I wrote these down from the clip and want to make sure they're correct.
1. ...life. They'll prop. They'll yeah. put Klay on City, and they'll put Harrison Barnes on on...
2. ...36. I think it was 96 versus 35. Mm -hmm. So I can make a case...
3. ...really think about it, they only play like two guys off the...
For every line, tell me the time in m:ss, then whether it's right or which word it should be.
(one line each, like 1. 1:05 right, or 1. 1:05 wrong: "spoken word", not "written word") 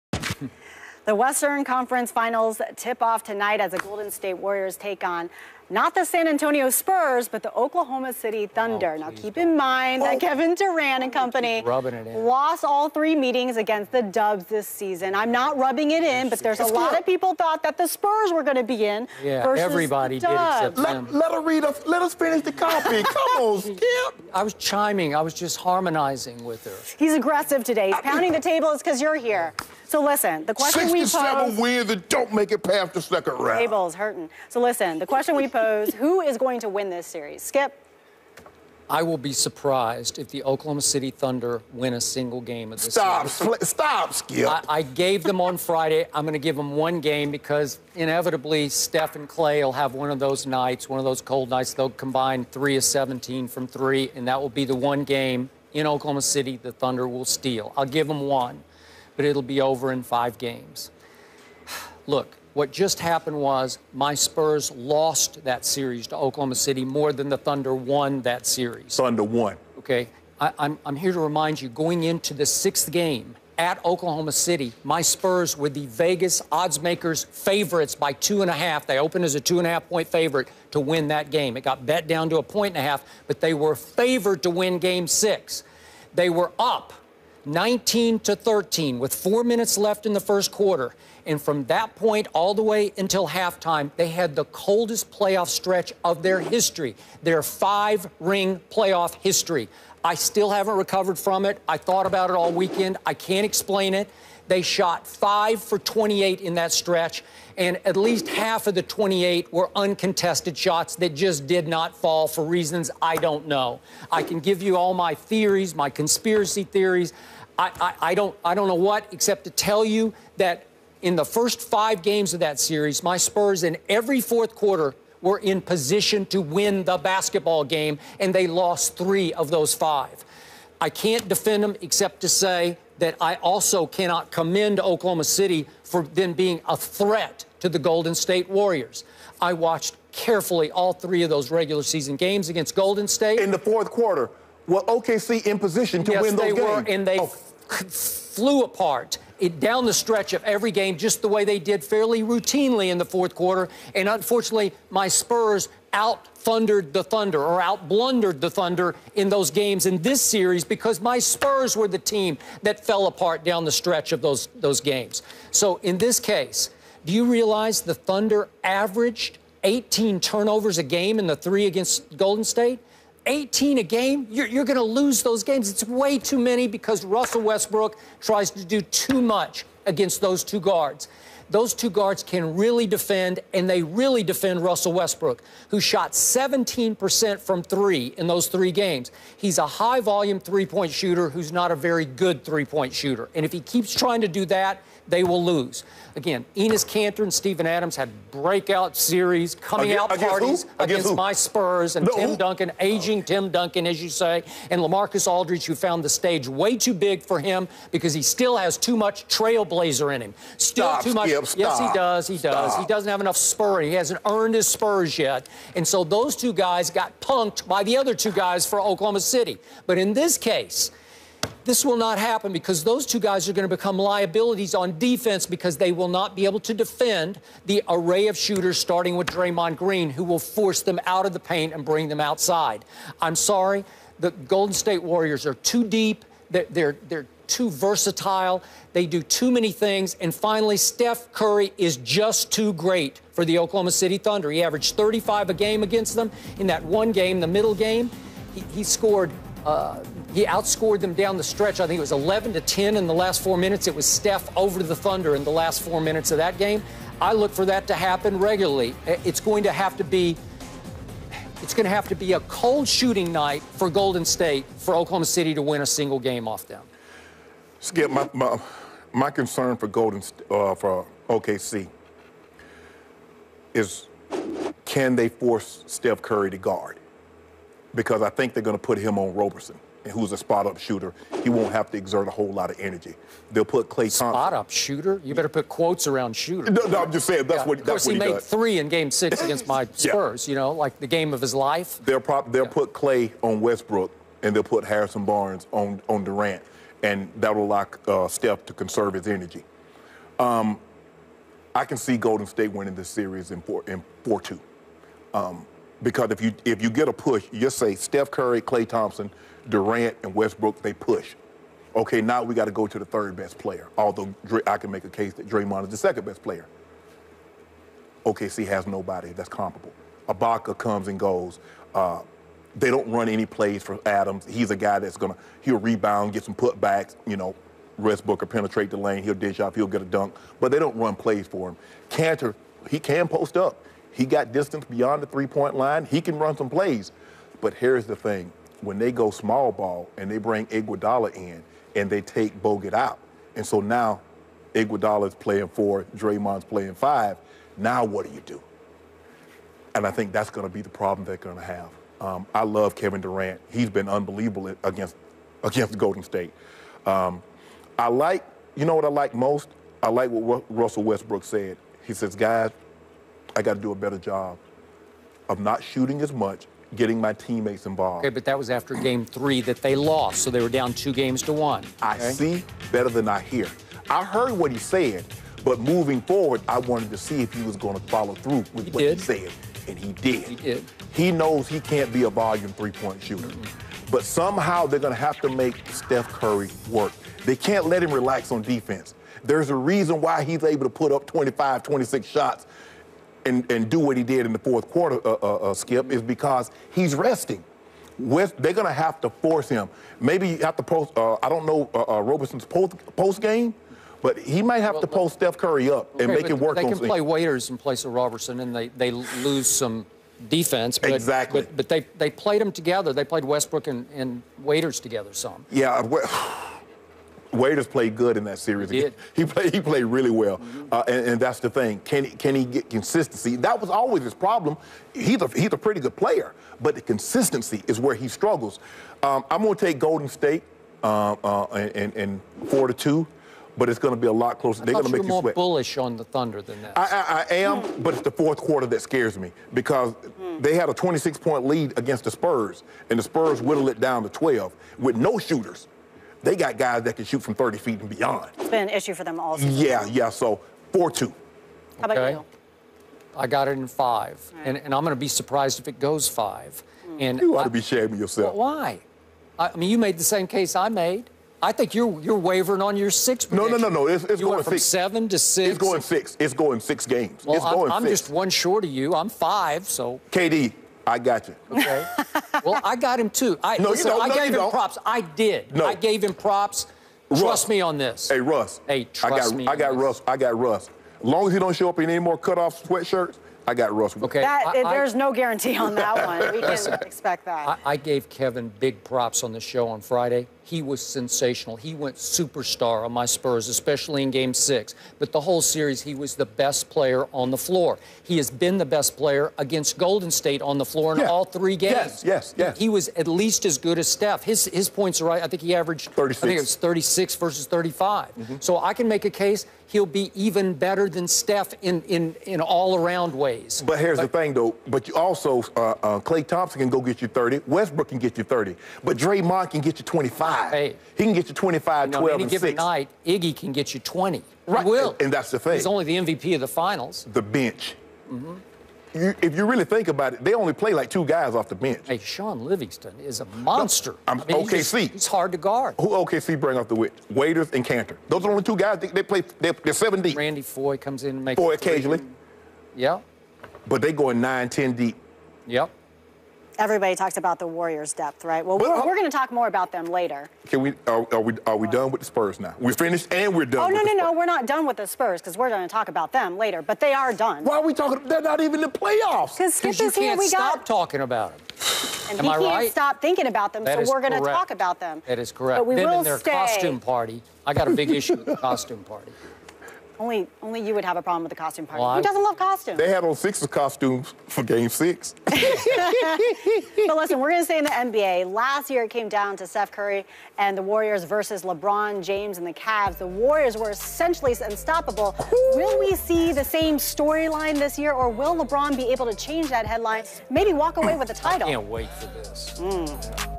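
1. 4:51 wrong: "Westbrook", not "City"
2. 8:26 wrong: "36", not "96"
3. 8:49 right.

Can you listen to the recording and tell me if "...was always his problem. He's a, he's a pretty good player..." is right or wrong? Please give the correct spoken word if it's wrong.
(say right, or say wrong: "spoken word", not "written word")
right.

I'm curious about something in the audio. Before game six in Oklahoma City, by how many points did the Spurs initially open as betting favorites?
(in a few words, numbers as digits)
2.5.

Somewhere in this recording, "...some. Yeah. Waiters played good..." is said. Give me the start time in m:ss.
6:55.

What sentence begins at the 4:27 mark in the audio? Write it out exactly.
Skip, my, my, my concern for Golden, uh, for OKC is can they force Steph Curry to guard?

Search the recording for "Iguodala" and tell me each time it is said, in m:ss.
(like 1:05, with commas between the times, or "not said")
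5:40, 5:44.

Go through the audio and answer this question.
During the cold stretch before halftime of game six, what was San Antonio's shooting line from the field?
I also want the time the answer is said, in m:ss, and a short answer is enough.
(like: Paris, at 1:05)
5 for 28, at 1:45.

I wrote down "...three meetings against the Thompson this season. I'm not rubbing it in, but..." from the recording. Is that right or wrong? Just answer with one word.
wrong.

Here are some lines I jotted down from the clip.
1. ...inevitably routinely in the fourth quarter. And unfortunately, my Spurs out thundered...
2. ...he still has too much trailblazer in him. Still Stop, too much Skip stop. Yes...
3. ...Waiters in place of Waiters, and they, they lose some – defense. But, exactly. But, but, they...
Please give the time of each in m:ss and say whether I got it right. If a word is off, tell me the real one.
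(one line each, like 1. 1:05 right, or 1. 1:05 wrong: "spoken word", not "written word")
1. 2:31 wrong: "fairly", not "inevitably"
2. 3:28 right
3. 6:47 wrong: "Roberson", not "Waiters".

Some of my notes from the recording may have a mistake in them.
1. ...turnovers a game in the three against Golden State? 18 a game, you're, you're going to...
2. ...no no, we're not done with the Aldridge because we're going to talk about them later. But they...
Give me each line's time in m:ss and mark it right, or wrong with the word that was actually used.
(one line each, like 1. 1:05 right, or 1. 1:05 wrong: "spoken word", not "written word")
1. 2:50 right
2. 9:14 wrong: "Spurs", not "Aldridge".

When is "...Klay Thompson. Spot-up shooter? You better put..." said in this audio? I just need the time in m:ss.
4:43.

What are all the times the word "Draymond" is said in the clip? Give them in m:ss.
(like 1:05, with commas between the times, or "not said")
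3:49, 5:15, 5:46, 8:39.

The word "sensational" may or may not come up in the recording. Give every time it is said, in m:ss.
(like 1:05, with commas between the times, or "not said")
8:11.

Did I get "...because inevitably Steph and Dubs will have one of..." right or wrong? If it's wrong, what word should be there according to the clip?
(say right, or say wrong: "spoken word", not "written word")
wrong: "Klay", not "Dubs".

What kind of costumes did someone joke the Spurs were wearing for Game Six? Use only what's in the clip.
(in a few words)
Sixers costumes.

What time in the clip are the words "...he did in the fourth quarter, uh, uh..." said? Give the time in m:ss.
6:34.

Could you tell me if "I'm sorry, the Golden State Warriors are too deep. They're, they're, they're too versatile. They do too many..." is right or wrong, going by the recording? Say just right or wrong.
right.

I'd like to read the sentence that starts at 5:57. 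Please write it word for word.
Um, I like, you know what I like most?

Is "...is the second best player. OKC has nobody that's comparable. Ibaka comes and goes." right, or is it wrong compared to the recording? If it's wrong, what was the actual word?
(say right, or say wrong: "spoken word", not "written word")
right.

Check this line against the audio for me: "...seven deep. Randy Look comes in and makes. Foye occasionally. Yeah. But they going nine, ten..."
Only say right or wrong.
wrong.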